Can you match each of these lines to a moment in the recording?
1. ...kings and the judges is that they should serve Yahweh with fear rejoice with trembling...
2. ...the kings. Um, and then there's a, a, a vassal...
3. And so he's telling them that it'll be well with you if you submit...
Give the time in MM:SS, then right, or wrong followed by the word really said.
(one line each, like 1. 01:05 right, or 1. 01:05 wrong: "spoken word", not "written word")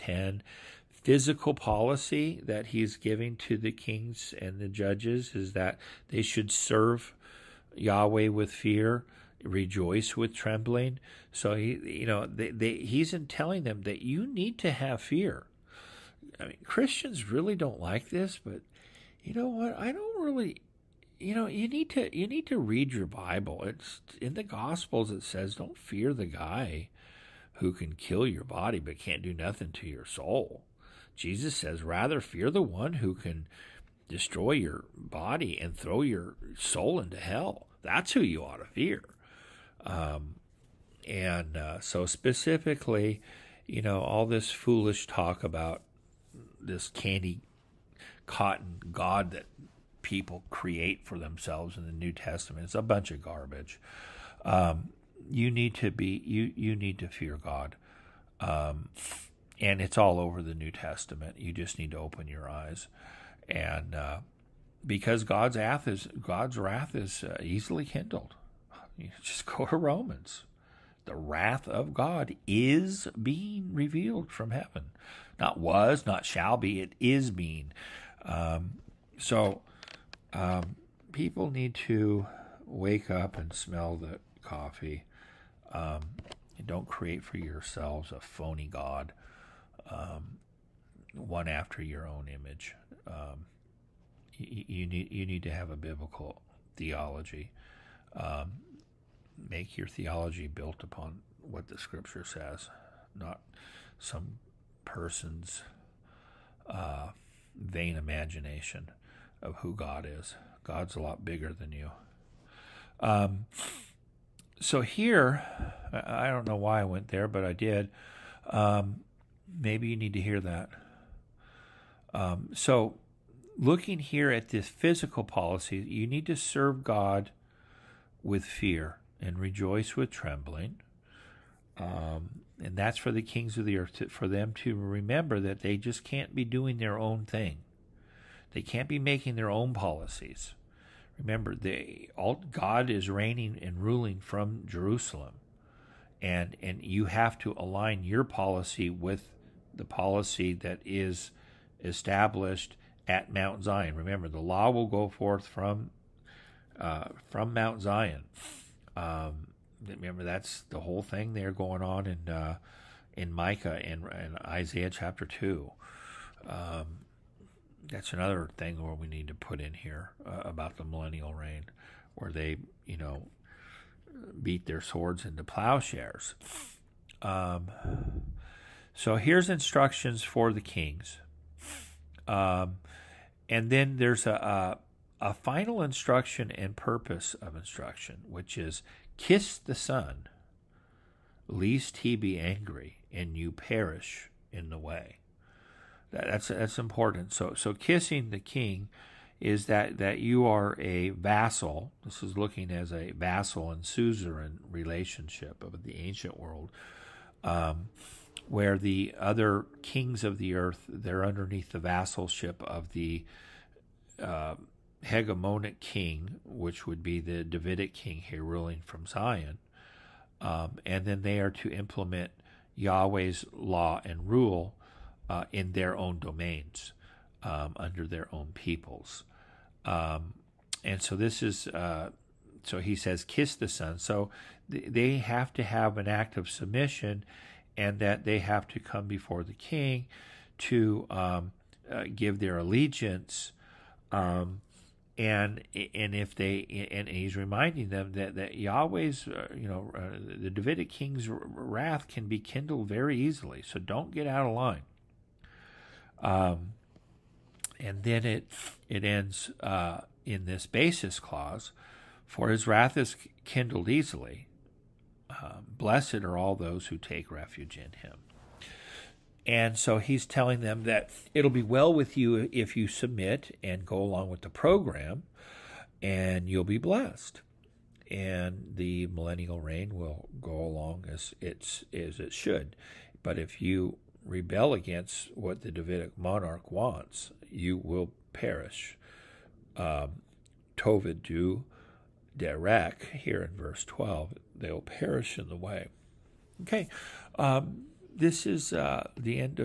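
1. 00:03 right
2. 03:00 wrong: "final", not "vassal"
3. 04:29 right.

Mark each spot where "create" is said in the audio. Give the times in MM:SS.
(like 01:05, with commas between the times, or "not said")
00:50, 01:26.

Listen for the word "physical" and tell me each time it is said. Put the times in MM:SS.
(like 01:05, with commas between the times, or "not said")
00:00, 02:04.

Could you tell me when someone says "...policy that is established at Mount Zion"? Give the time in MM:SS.
02:29.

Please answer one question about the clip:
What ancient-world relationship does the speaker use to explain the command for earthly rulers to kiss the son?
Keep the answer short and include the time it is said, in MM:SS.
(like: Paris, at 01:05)
Vassal and suzerain, at 03:23.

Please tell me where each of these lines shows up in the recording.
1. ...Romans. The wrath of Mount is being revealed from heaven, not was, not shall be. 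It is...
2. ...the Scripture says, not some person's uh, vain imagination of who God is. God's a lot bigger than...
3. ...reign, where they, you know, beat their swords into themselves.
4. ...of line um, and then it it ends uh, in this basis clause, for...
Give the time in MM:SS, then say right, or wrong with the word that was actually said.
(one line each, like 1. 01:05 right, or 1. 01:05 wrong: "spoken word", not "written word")
1. 01:09 wrong: "God", not "Mount"
2. 01:41 right
3. 02:51 wrong: "plowshares", not "themselves"
4. 04:14 right.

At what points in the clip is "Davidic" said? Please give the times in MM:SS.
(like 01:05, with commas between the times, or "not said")
03:37, 04:10, 04:45.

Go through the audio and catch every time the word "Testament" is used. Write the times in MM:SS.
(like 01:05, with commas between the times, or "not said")
00:52, 01:00.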